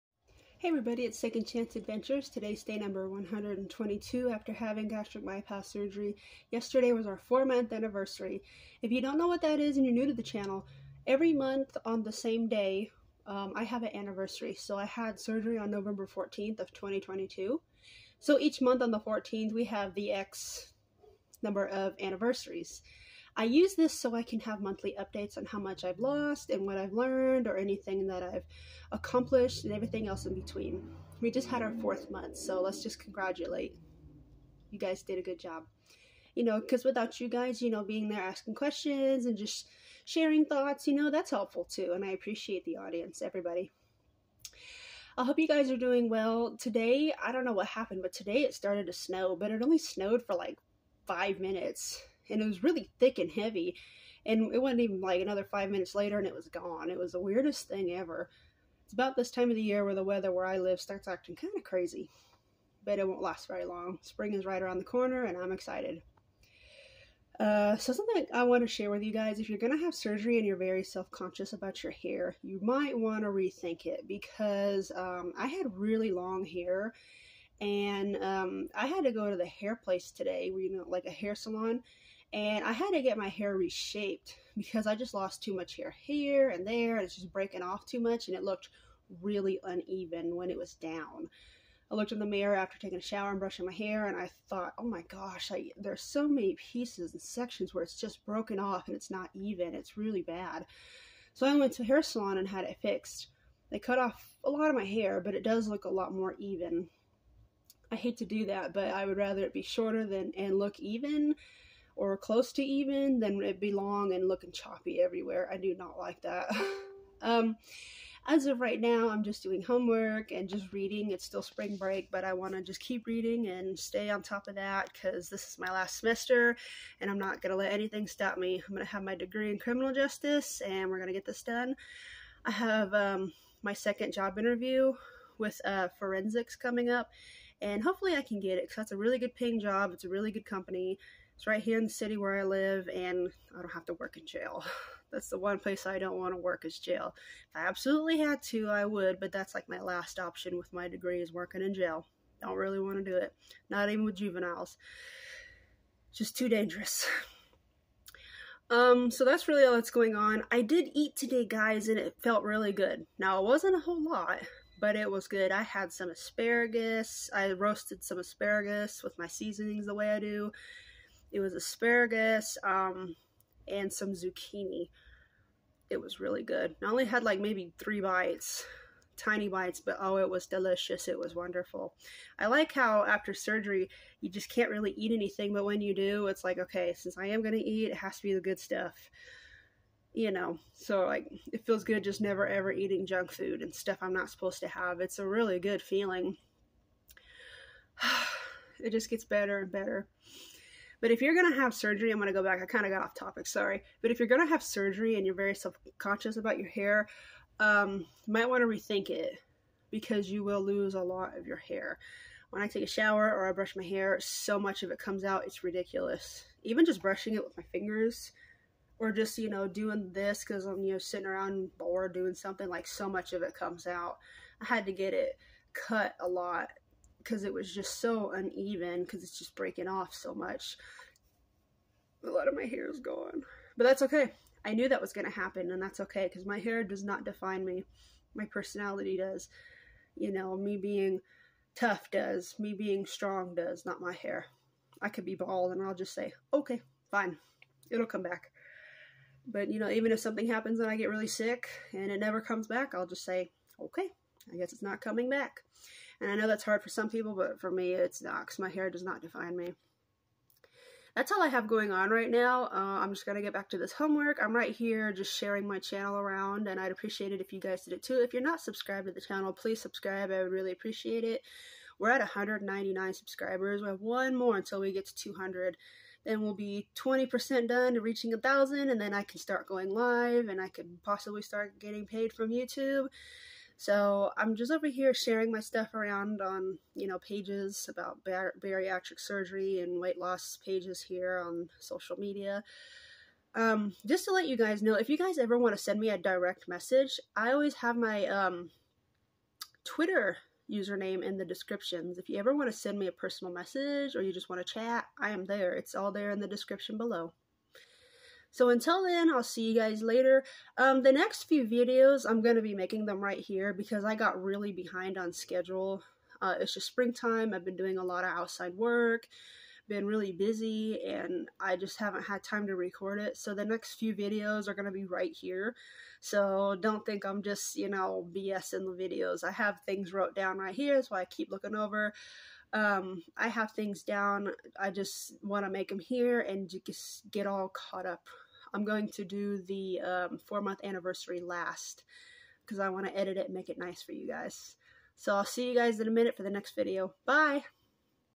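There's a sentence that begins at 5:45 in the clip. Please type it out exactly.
So I'll see you guys in a minute for the next video.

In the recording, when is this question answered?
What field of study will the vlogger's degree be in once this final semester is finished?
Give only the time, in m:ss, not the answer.
2:09.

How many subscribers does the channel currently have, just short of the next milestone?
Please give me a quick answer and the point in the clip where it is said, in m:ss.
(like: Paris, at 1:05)
199, at 4:32.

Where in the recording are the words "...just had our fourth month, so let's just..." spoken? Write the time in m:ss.
0:31.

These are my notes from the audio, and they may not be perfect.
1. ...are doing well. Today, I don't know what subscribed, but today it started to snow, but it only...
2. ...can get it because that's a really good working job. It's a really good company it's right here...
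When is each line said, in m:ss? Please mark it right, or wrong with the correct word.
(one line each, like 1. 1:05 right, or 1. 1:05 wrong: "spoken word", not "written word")
1. 0:45 wrong: "happened", not "subscribed"
2. 2:18 wrong: "paying", not "working".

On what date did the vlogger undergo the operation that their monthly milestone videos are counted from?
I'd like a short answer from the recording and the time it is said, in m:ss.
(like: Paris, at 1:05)
November 14, 2022, at 0:15.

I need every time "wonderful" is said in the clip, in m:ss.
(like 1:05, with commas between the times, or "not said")
3:01.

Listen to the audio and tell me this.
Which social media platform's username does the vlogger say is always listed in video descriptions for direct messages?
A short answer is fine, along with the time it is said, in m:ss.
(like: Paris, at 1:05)
Twitter, at 4:59.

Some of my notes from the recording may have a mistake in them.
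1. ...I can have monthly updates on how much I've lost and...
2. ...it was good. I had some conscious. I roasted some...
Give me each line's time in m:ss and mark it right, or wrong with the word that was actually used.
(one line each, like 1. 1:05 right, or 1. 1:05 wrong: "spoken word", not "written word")
1. 0:24 right
2. 2:44 wrong: "asparagus", not "conscious".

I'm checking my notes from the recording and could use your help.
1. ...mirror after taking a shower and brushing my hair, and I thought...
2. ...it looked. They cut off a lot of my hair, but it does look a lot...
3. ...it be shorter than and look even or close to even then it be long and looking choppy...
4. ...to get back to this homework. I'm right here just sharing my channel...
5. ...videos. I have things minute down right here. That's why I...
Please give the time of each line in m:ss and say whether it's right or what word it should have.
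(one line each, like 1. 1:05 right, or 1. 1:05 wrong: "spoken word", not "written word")
1. 1:32 right
2. 1:42 wrong: "fixed", not "looked"
3. 1:49 right
4. 4:23 right
5. 5:28 wrong: "wrote", not "minute".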